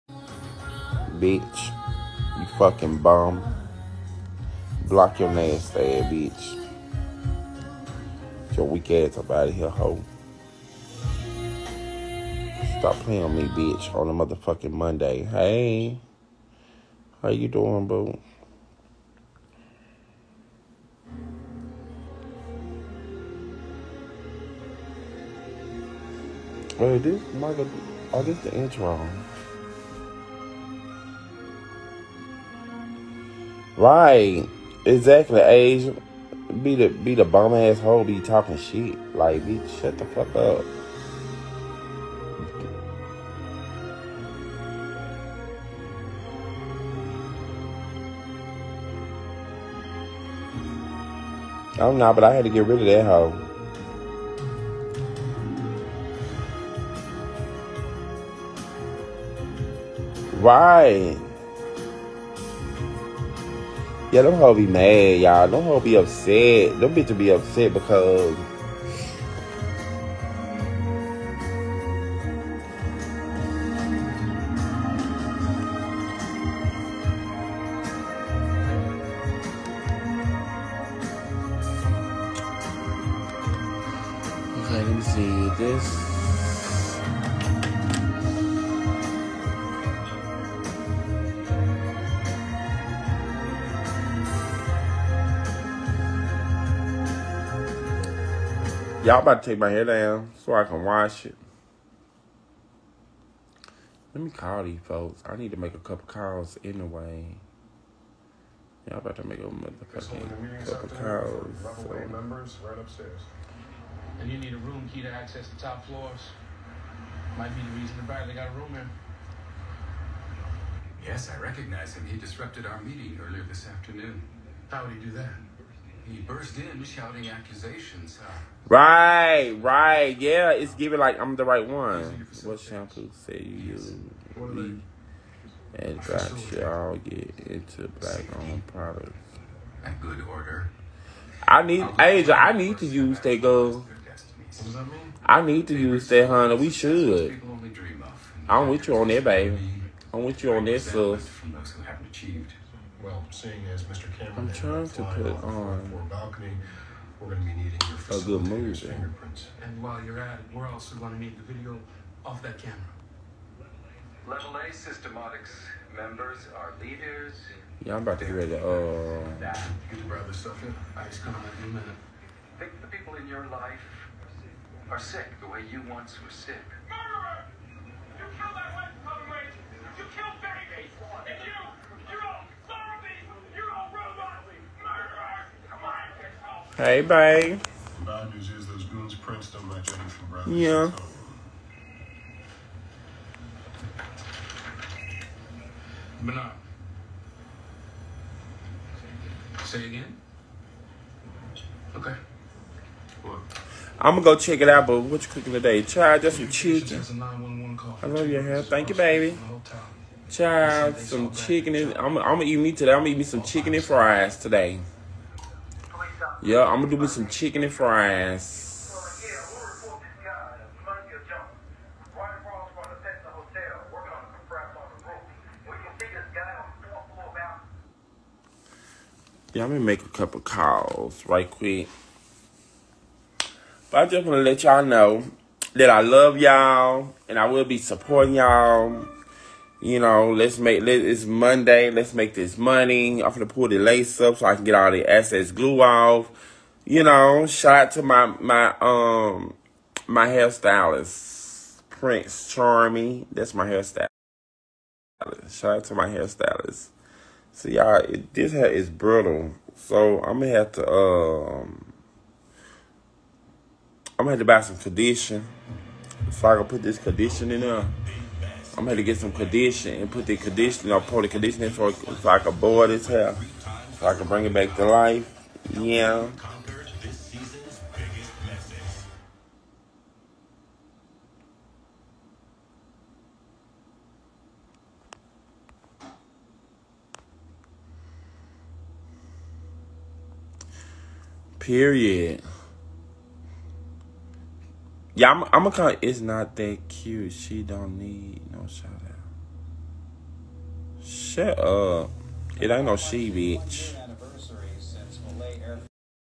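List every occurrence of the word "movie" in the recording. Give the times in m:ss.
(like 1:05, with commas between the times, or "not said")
2:38.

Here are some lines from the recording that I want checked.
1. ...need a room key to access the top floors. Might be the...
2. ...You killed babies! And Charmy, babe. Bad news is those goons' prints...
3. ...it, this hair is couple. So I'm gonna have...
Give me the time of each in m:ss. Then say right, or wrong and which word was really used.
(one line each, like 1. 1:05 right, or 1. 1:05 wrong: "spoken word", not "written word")
1. 1:54 right
2. 2:59 wrong: "Hey", not "Charmy"
3. 4:18 wrong: "brittle", not "couple".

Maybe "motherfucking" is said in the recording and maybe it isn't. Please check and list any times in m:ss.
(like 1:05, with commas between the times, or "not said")
0:14, 1:49.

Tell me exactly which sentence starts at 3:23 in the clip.
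I'm gonna go check it out, but what you cooking today?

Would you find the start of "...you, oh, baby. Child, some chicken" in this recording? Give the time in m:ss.
3:28.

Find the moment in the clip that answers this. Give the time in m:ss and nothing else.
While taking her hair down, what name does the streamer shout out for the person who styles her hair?
4:11.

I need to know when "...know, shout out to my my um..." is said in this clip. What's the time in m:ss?
4:07.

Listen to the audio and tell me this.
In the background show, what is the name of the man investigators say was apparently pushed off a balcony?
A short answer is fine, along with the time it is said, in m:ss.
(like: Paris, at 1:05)
Mr. Cameron, at 2:33.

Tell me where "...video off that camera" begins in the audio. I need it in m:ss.
2:41.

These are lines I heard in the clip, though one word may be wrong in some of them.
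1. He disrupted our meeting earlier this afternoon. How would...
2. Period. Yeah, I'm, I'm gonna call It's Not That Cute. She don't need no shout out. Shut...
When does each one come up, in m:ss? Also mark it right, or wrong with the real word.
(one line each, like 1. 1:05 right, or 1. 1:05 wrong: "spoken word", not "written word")
1. 2:02 right
2. 4:51 right.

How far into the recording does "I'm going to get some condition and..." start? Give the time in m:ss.
4:28.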